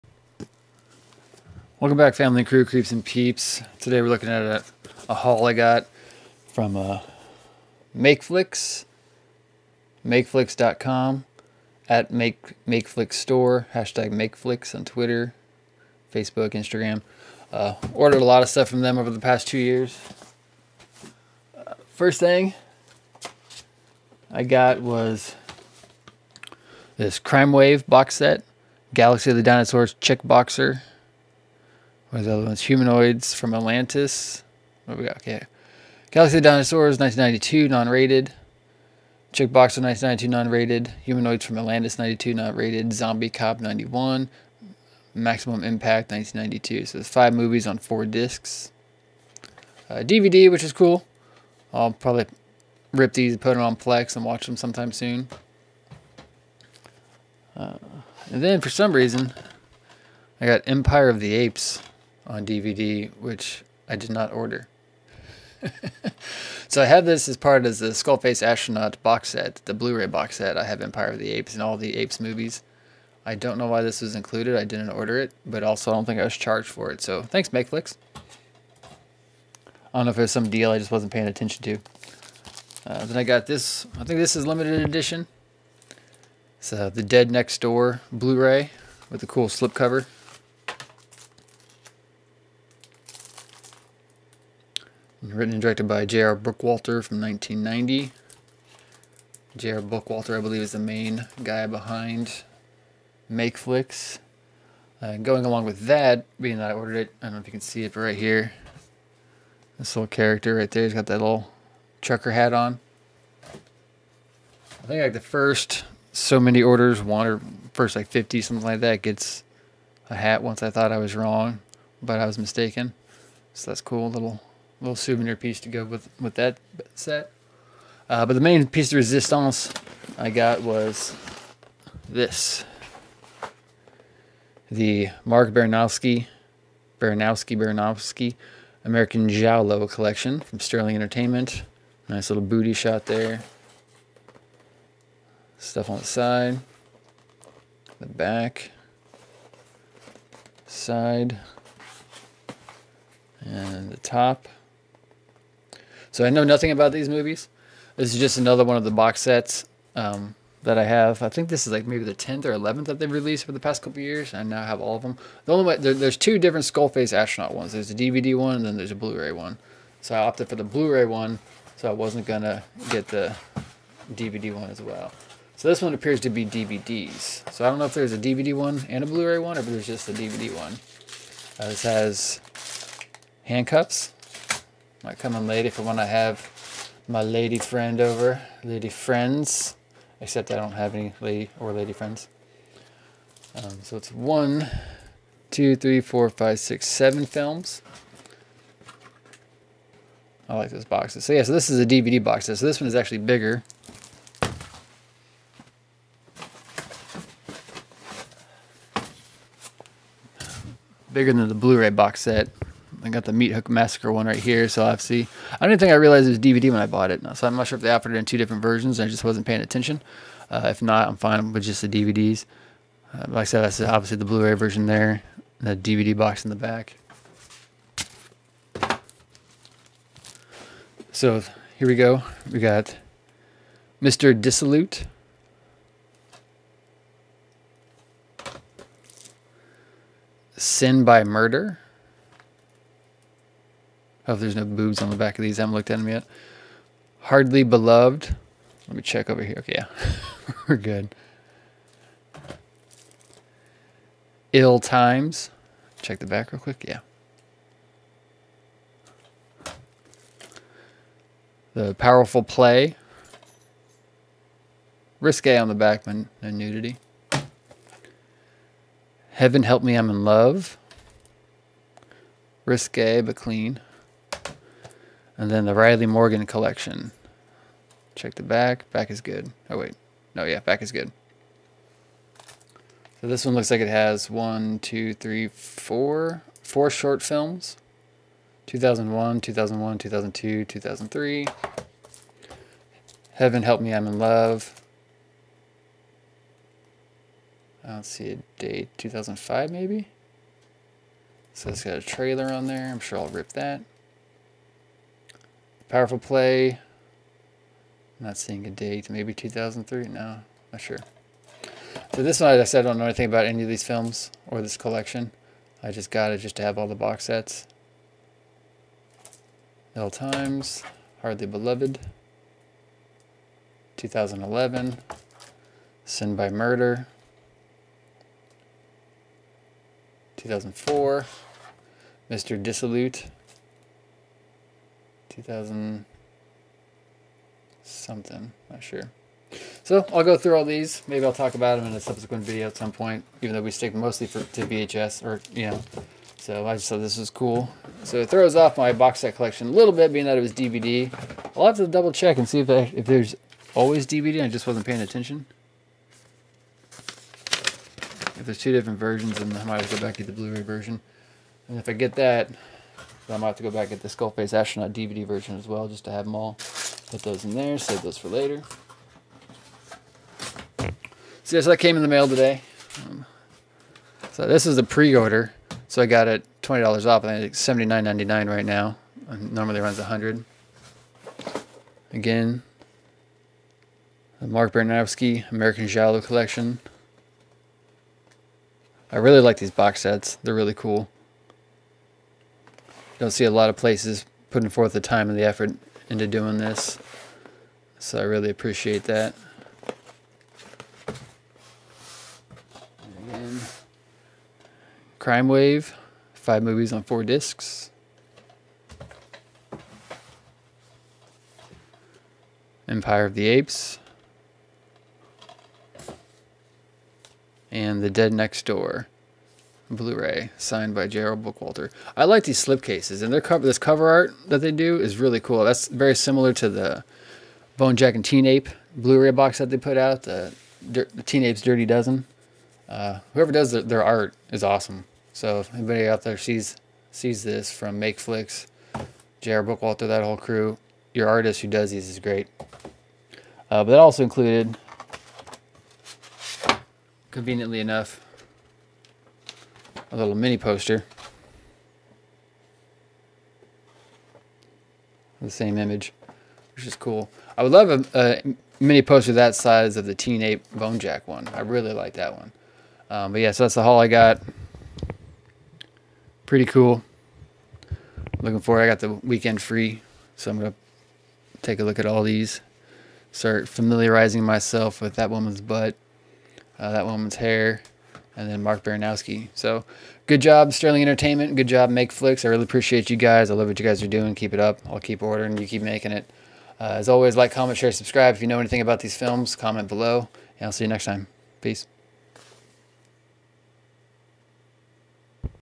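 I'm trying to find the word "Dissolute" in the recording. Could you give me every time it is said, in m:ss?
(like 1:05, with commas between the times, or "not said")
3:54, 5:32.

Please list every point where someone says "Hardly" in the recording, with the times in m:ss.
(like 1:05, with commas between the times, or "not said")
4:07, 5:21.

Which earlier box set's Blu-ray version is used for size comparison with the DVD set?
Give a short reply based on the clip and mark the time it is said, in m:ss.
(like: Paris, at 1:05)
Meat Hook Massacre, at 3:33.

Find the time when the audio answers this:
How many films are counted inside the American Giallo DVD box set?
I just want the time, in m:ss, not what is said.
3:16.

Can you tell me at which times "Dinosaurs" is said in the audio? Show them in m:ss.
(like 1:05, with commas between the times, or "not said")
0:29, 0:36.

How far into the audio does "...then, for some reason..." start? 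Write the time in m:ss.
0:58.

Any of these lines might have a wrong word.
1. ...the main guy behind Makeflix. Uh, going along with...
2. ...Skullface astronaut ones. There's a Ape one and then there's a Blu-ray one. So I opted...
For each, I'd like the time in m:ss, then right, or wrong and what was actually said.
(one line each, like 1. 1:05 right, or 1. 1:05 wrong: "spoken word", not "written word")
1. 1:40 right
2. 2:46 wrong: "DVD", not "Ape".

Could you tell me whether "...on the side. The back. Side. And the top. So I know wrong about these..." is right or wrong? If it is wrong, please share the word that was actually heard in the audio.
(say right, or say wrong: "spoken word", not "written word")
wrong: "nothing", not "wrong".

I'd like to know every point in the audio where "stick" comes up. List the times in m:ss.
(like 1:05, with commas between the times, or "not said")
5:43.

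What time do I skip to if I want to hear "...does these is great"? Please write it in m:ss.
7:21.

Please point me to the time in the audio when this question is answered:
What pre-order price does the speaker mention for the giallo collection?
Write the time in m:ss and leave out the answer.
6:17.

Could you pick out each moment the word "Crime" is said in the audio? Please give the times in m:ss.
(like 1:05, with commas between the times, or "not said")
0:27, 6:45.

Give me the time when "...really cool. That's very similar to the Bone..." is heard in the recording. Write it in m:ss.
7:05.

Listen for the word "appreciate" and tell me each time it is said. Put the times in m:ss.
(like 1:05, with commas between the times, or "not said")
6:38, 8:02.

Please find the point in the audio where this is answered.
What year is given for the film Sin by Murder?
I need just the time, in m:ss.
5:30.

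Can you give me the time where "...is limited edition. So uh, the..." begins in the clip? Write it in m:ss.
1:24.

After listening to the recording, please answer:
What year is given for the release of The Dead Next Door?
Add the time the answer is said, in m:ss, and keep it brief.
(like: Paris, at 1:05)
1990, at 1:37.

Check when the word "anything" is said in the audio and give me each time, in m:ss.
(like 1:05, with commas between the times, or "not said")
5:13, 8:08.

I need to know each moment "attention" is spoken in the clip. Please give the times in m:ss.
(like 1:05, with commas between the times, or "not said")
1:21, 3:39, 5:55.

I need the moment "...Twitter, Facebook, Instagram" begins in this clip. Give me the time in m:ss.
0:14.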